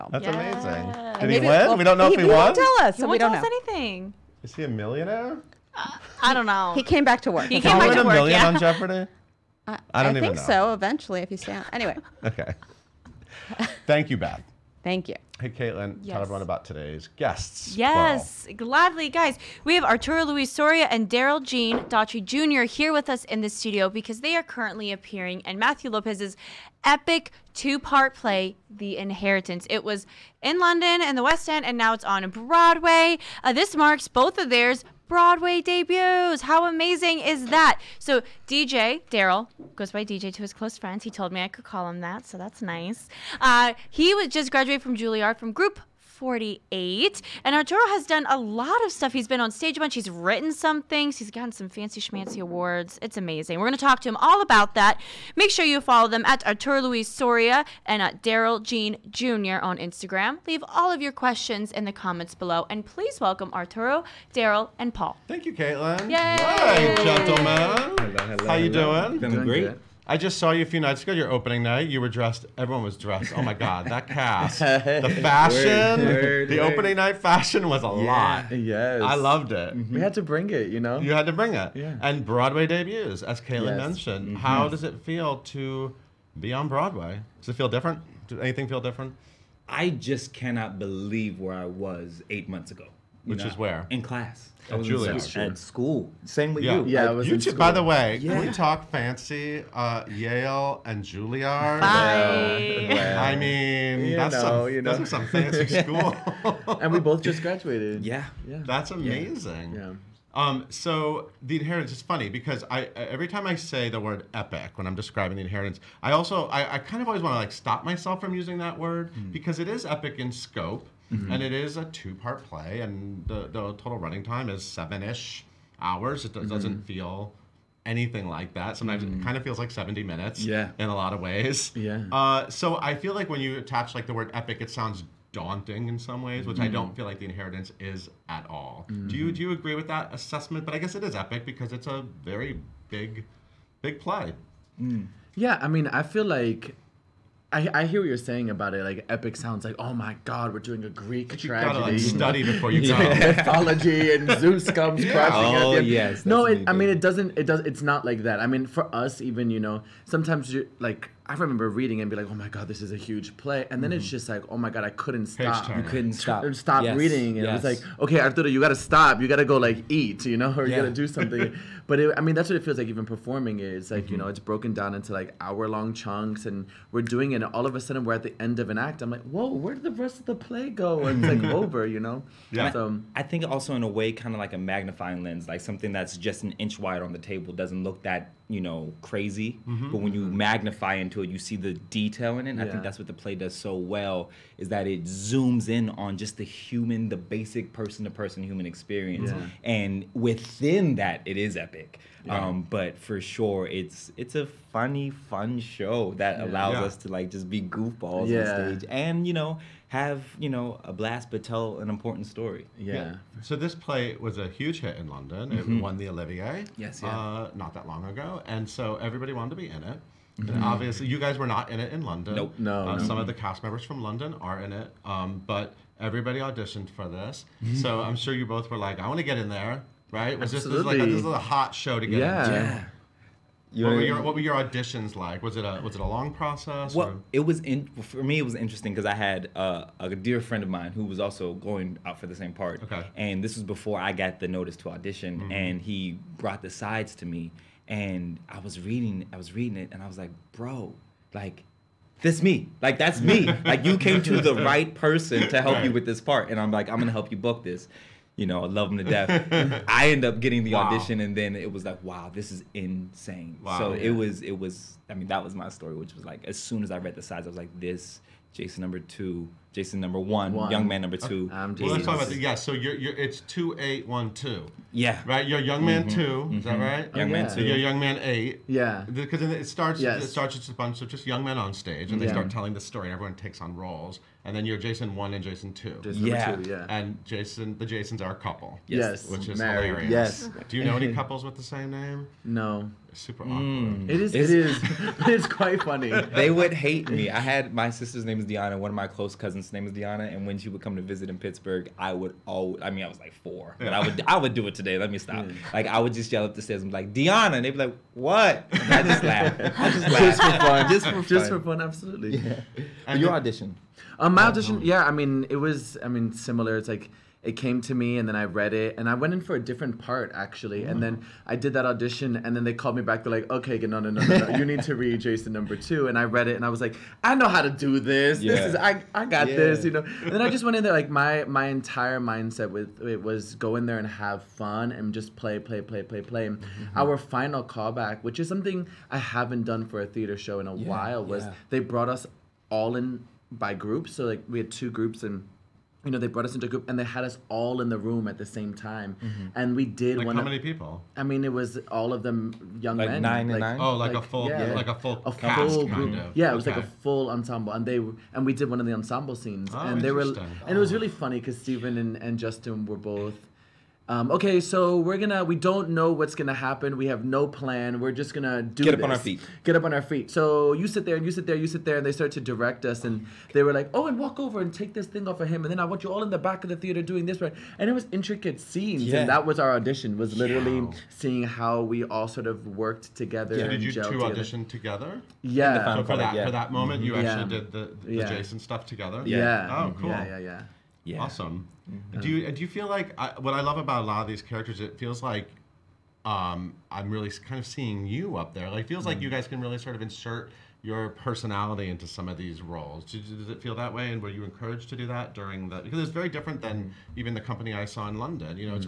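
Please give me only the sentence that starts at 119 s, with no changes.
because it is epic in scope Mm-hmm.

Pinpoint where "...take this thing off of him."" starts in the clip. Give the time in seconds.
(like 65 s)
374 s.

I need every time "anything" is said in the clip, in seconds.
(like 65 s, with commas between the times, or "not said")
3 s, 88 s, 127 s.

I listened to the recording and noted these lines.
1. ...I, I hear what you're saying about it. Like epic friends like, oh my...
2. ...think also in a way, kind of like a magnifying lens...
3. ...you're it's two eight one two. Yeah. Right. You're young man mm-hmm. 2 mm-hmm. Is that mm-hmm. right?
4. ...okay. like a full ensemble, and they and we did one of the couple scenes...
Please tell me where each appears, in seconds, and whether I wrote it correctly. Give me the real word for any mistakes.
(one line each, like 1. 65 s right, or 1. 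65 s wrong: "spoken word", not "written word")
1. 147 s wrong: "sounds", not "friends"
2. 183 s right
3. 272 s right
4. 356 s wrong: "ensemble", not "couple".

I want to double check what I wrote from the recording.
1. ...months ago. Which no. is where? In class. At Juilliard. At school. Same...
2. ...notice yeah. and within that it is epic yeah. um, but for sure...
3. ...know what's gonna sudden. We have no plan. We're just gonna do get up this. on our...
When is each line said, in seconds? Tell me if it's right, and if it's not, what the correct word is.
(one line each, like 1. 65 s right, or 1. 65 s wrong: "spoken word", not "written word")
1. 92 s right
2. 198 s wrong: "experience", not "notice"
3. 365 s wrong: "happen", not "sudden".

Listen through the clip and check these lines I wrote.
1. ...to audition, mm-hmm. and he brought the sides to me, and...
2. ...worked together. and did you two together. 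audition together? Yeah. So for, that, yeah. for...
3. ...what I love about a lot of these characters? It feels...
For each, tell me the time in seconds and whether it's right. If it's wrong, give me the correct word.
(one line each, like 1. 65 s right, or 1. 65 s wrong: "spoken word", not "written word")
1. 244 s right
2. 382 s right
3. 393 s right.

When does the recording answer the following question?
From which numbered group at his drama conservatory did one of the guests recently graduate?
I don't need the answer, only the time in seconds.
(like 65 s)
45 s.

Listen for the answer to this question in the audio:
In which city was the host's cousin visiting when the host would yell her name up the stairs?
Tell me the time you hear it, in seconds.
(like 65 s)
301 s.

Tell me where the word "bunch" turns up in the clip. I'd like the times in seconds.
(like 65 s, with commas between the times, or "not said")
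49 s, 280 s.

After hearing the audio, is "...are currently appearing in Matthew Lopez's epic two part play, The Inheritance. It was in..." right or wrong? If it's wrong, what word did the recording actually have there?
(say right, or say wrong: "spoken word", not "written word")
right.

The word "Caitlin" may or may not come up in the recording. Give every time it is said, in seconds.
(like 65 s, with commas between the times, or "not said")
15 s, 65 s, 83 s.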